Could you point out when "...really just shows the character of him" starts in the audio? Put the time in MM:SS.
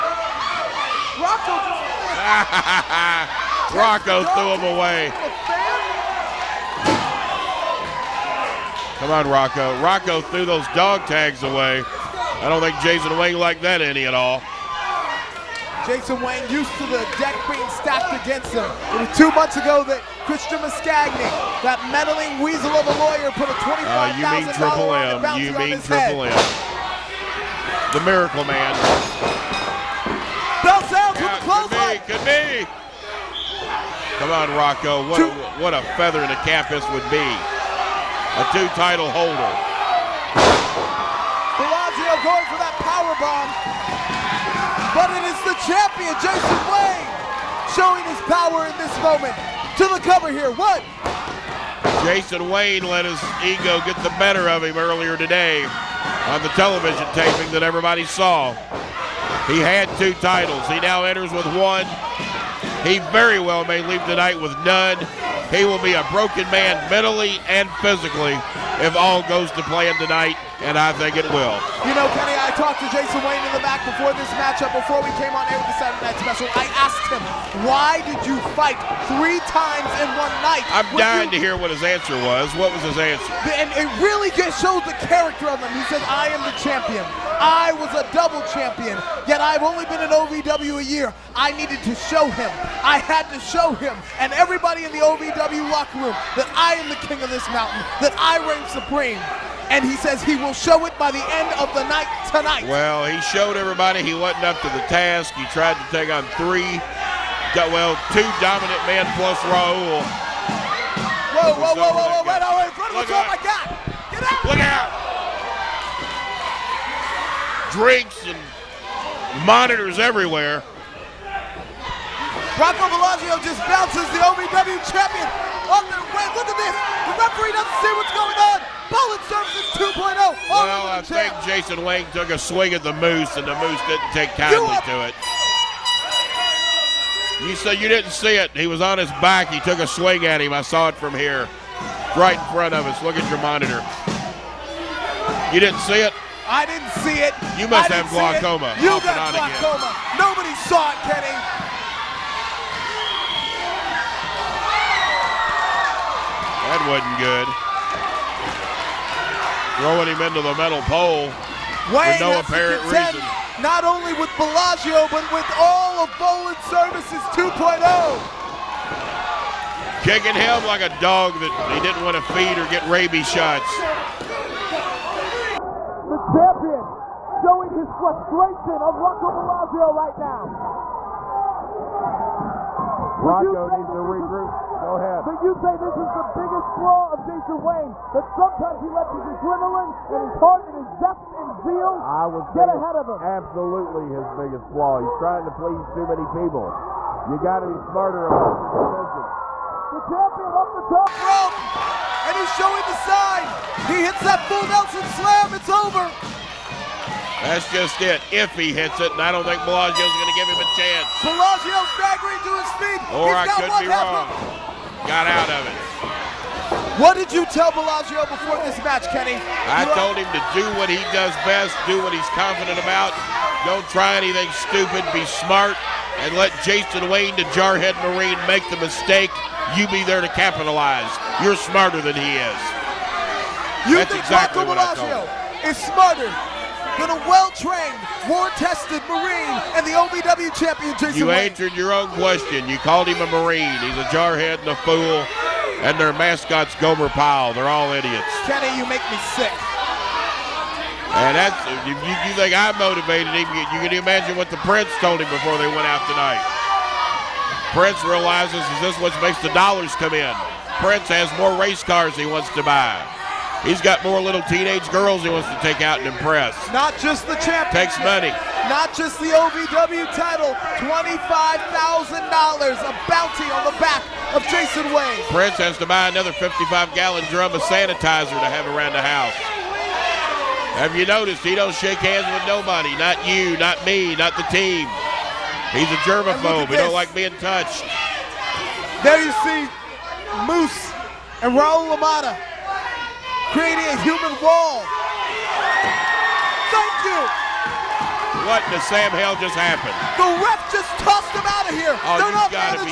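01:24.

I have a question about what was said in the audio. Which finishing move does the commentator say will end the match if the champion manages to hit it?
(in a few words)
full Nelson slam.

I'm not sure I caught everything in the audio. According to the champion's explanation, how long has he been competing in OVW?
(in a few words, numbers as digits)
a year.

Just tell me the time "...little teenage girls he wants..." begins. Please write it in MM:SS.
04:24.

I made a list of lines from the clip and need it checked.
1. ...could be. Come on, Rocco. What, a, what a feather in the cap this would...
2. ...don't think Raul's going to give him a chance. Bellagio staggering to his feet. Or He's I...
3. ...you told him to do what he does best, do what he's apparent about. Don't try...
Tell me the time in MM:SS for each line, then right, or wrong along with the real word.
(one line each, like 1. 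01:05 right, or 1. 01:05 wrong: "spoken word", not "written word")
1. 00:32 right
2. 03:29 wrong: "Bellagio", not "Raul"
3. 03:39 wrong: "confident", not "apparent".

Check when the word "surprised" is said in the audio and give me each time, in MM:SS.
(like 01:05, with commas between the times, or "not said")
not said.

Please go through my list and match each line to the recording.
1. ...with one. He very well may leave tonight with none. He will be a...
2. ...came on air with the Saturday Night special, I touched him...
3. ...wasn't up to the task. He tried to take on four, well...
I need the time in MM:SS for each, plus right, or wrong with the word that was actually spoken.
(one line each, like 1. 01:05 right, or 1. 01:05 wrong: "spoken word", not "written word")
1. 01:01 right
2. 01:15 wrong: "asked", not "touched"
3. 01:44 wrong: "three", not "four".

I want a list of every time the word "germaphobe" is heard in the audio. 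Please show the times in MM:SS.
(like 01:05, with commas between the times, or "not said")
04:46.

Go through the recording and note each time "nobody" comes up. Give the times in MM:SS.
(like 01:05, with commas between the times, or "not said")
02:30, 04:42.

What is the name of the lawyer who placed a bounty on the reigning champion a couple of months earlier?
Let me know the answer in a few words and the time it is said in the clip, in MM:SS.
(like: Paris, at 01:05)
Christian Mascagni, at 00:20.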